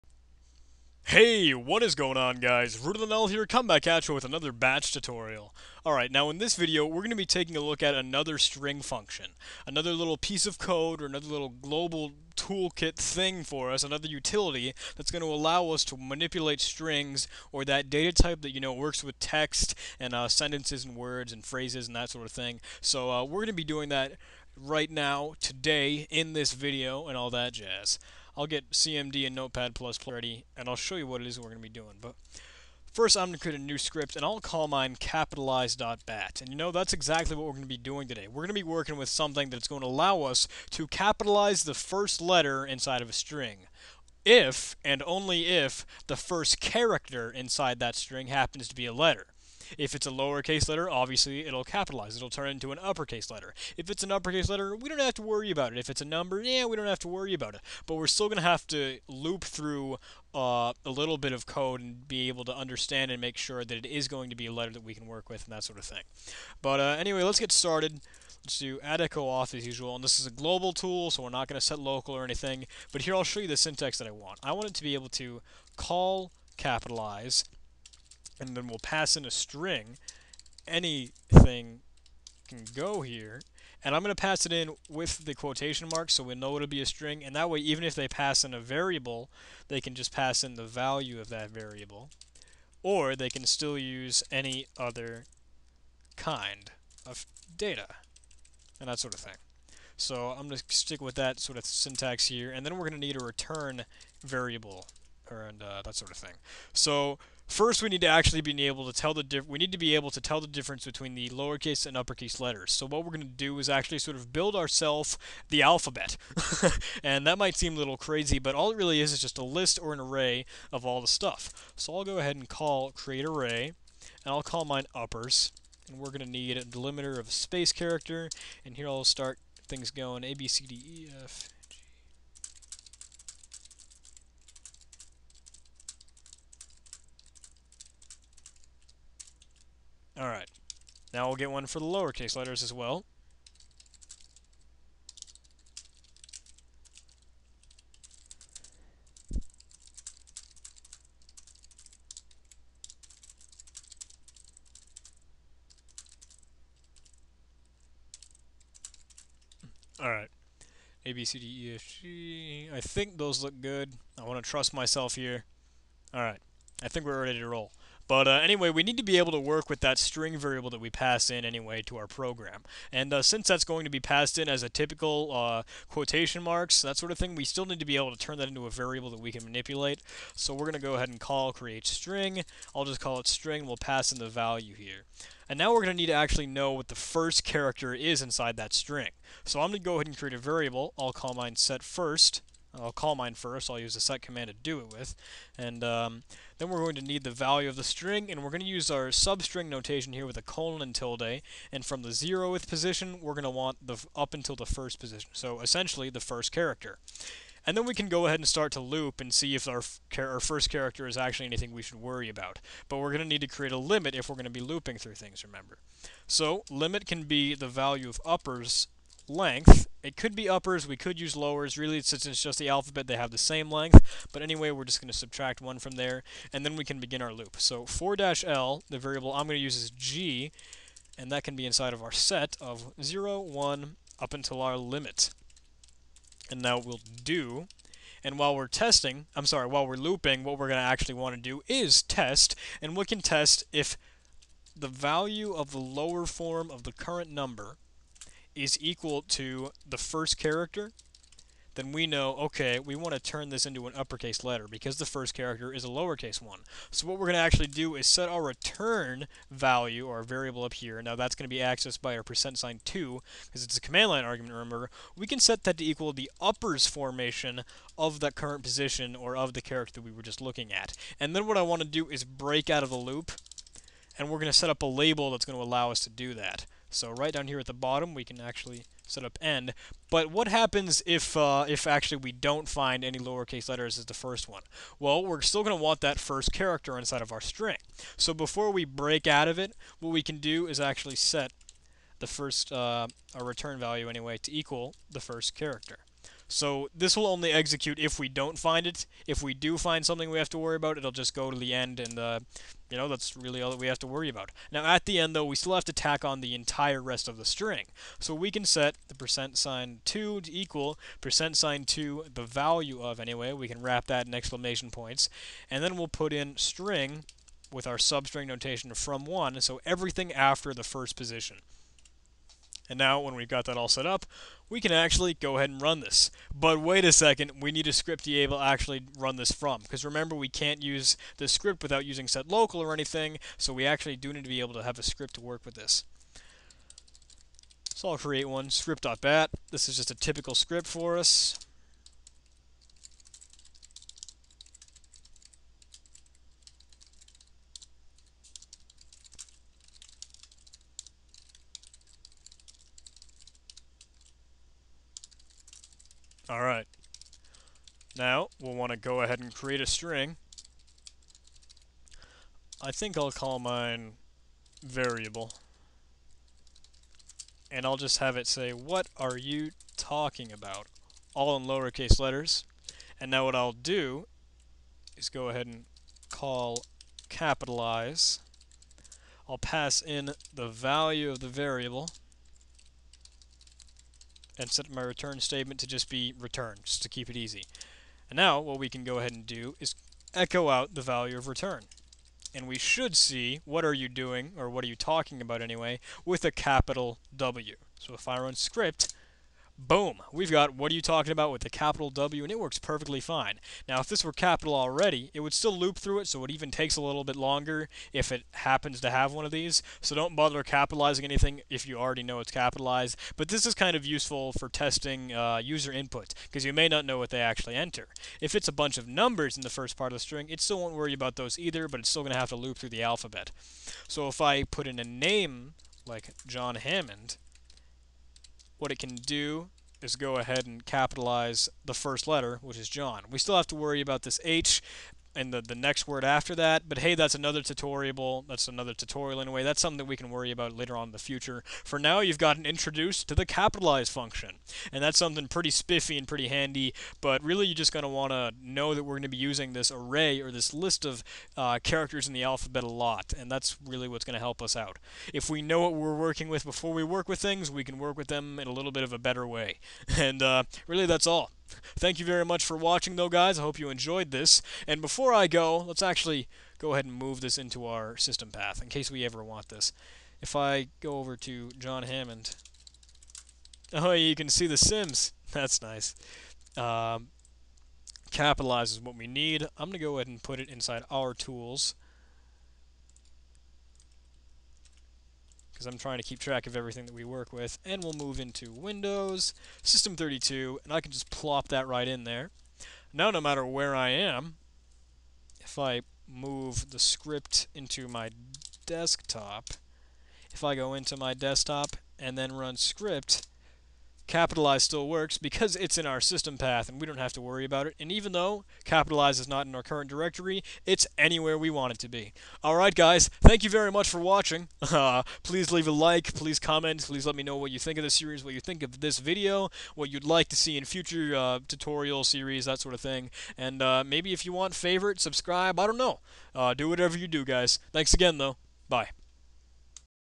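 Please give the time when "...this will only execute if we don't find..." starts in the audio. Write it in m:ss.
4:56.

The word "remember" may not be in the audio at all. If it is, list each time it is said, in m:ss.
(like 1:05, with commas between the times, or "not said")
3:35, 4:24, 5:30.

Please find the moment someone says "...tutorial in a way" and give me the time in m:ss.
7:18.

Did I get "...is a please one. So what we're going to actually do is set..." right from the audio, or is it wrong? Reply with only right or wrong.
wrong.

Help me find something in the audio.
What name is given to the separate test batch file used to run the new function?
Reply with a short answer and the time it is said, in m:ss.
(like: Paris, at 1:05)
script.bat, at 5:38.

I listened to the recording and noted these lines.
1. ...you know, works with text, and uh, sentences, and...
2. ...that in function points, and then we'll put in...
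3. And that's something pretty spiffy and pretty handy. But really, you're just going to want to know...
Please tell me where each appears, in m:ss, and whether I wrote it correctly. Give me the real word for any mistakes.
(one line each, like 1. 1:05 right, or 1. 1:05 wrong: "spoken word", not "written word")
1. 0:18 right
2. 5:14 wrong: "exclamation", not "function"
3. 7:24 right.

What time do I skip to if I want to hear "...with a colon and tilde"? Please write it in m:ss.
3:20.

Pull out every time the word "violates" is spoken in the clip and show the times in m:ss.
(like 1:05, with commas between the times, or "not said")
not said.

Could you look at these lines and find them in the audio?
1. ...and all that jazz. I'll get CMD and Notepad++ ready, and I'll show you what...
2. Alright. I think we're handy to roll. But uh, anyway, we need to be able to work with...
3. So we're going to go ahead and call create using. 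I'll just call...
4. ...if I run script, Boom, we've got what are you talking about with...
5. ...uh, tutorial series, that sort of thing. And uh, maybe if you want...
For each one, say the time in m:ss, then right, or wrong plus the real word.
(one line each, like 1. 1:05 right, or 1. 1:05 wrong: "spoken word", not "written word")
1. 0:27 right
2. 2:46 wrong: "ready", not "handy"
3. 3:00 wrong: "string", not "using"
4. 6:38 right
5. 8:41 right.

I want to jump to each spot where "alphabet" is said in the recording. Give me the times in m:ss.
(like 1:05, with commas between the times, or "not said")
1:55, 3:42, 7:03, 7:32.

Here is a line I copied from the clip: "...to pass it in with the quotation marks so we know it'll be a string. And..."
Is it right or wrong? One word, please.
right.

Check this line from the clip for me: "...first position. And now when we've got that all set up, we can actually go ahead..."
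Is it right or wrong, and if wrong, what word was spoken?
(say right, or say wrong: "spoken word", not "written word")
right.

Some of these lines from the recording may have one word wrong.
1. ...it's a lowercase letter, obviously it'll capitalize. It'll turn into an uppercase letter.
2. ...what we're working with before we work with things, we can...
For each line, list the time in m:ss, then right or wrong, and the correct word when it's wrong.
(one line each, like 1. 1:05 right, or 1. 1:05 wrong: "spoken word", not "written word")
1. 0:49 right
2. 7:35 right.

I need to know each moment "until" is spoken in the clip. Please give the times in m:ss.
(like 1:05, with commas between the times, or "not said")
3:24, 3:54.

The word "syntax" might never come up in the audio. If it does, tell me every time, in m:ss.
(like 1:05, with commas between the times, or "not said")
1:13, 1:41.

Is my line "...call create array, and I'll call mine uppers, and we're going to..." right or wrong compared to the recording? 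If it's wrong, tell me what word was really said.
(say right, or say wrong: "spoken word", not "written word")
right.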